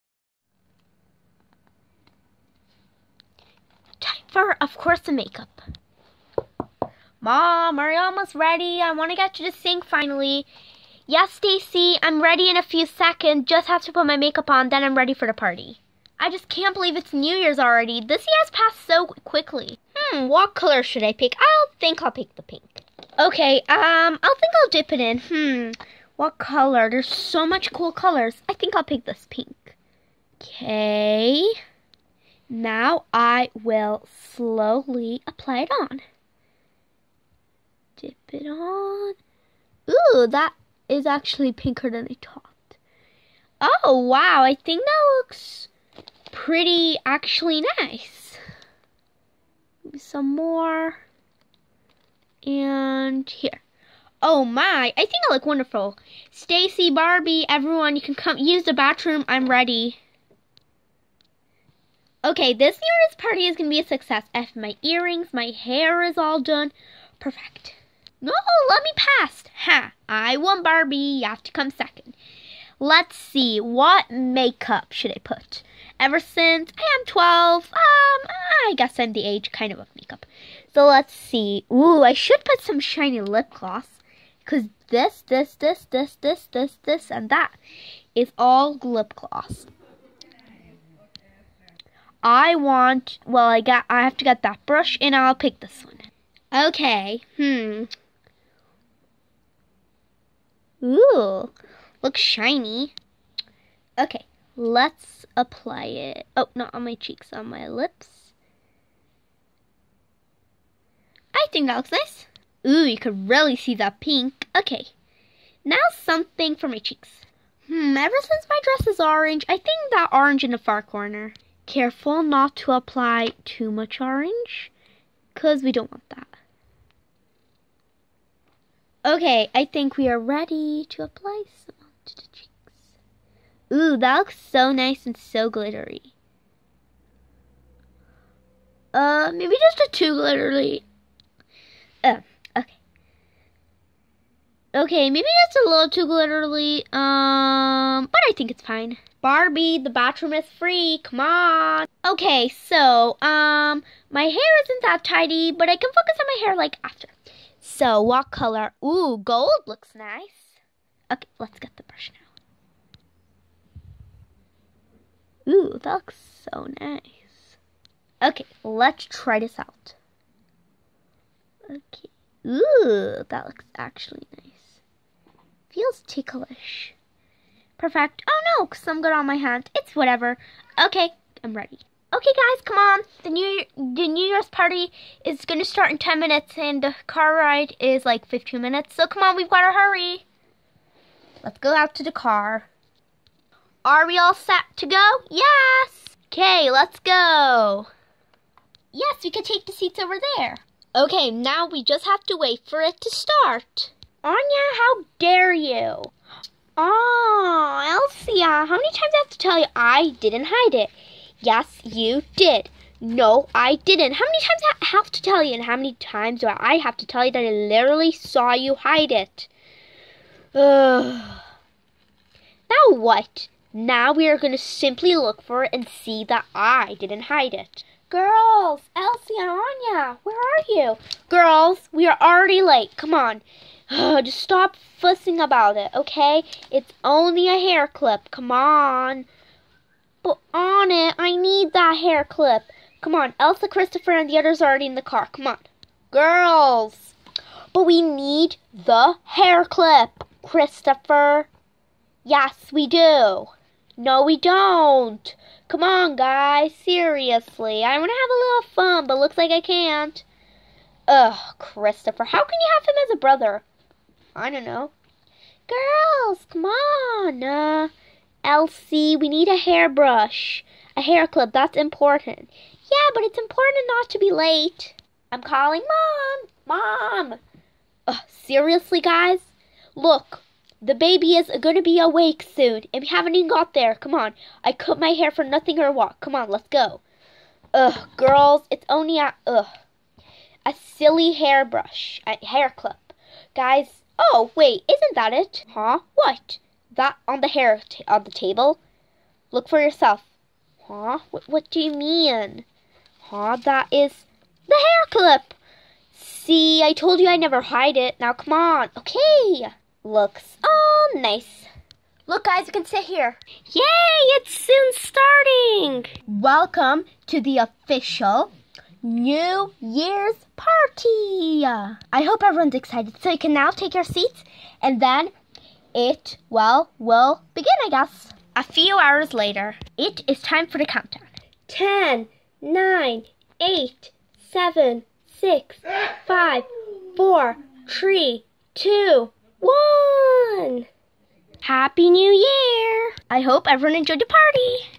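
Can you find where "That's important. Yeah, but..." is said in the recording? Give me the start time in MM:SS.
04:31.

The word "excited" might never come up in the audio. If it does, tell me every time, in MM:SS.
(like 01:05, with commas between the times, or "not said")
05:22.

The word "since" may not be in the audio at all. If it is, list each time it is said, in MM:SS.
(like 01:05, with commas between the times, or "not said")
01:16, 01:58.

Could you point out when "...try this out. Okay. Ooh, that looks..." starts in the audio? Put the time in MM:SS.
02:49.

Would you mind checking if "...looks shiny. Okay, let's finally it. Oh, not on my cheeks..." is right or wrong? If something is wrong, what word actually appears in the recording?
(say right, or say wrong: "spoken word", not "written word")
wrong: "apply", not "finally".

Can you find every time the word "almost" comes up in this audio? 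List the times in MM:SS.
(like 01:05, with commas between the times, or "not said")
00:07.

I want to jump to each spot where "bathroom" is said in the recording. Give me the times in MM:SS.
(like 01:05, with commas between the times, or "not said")
00:58, 02:29.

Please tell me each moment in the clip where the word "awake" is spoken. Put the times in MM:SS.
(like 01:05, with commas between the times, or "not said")
04:41.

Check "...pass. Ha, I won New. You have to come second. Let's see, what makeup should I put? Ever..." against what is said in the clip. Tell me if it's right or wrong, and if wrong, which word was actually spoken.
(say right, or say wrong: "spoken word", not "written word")
wrong: "Barbie", not "New".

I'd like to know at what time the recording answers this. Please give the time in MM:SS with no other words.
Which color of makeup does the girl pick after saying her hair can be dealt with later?
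02:38.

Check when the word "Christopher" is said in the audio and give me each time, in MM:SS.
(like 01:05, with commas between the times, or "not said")
04:03, 04:10, 04:21.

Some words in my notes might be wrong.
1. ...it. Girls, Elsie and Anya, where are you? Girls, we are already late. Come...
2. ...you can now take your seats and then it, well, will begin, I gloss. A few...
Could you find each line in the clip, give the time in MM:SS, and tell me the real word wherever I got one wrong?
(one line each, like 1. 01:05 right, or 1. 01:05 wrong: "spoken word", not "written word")
1. 03:47 right
2. 05:23 wrong: "guess", not "gloss".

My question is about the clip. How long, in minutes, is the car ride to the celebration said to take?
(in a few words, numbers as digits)
15 minutes.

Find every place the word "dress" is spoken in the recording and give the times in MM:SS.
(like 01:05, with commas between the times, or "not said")
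01:58.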